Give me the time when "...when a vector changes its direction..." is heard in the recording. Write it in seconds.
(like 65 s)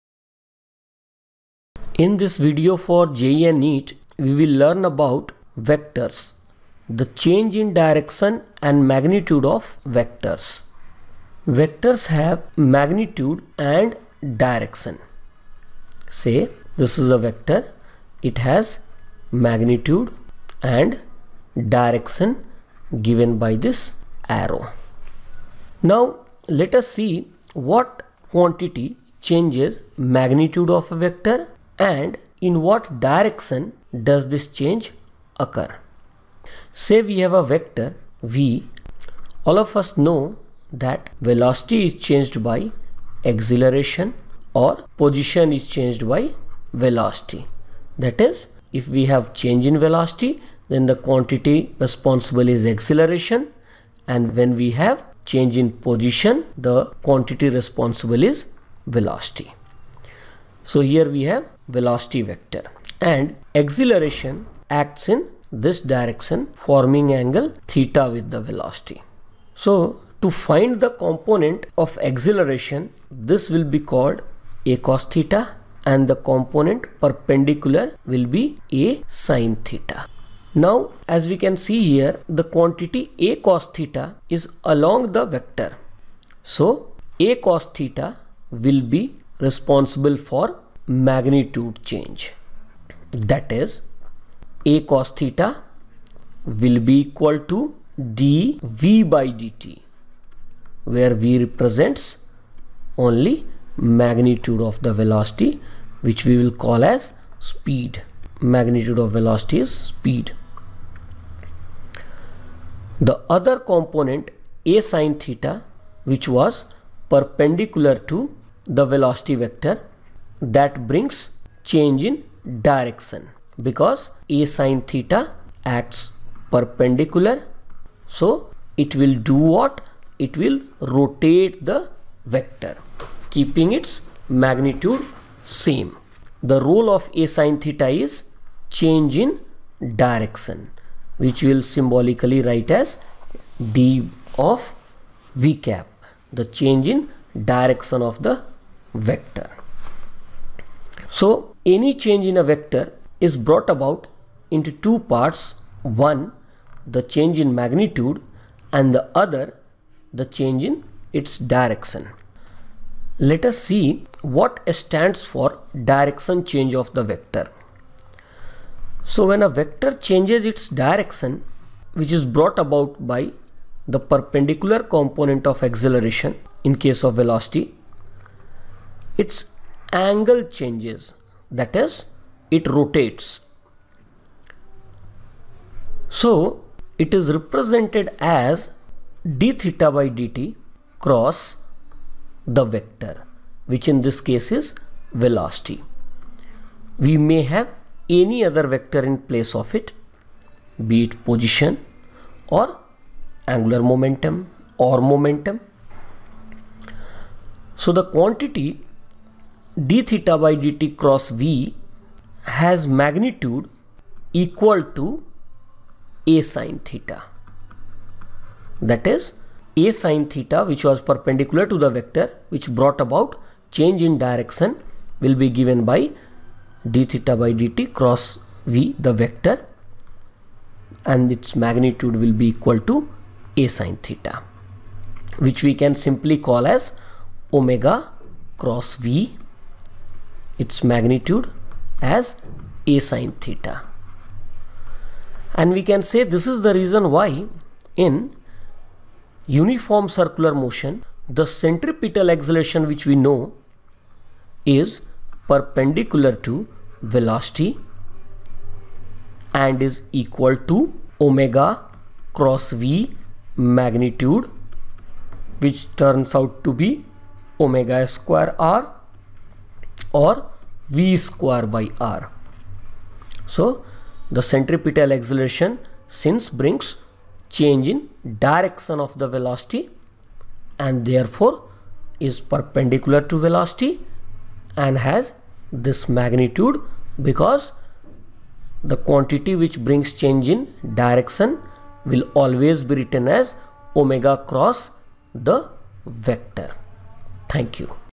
169 s.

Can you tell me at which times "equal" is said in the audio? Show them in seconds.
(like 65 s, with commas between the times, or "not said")
97 s, 214 s, 232 s, 260 s.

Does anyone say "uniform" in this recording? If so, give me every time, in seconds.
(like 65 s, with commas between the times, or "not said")
249 s.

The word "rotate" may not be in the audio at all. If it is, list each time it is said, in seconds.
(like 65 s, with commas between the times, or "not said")
130 s, 182 s.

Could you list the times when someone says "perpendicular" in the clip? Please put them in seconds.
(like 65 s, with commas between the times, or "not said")
77 s, 117 s, 126 s, 173 s, 221 s, 255 s, 282 s.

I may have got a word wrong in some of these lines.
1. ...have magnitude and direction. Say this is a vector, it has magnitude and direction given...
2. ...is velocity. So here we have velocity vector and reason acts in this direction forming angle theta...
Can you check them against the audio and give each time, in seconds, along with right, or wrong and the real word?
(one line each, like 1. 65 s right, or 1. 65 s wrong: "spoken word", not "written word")
1. 12 s right
2. 58 s wrong: "acceleration", not "reason".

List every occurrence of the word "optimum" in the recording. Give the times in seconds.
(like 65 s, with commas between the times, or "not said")
not said.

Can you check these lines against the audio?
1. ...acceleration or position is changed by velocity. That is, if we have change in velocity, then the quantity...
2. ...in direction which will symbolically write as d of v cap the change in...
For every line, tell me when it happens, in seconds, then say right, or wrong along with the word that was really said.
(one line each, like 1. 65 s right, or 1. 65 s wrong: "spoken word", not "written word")
1. 43 s right
2. 139 s right.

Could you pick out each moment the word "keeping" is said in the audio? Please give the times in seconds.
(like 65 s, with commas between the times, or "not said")
133 s.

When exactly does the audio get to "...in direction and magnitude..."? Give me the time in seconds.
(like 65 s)
7 s.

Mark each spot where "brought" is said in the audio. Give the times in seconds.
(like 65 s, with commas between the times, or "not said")
153 s, 172 s, 222 s.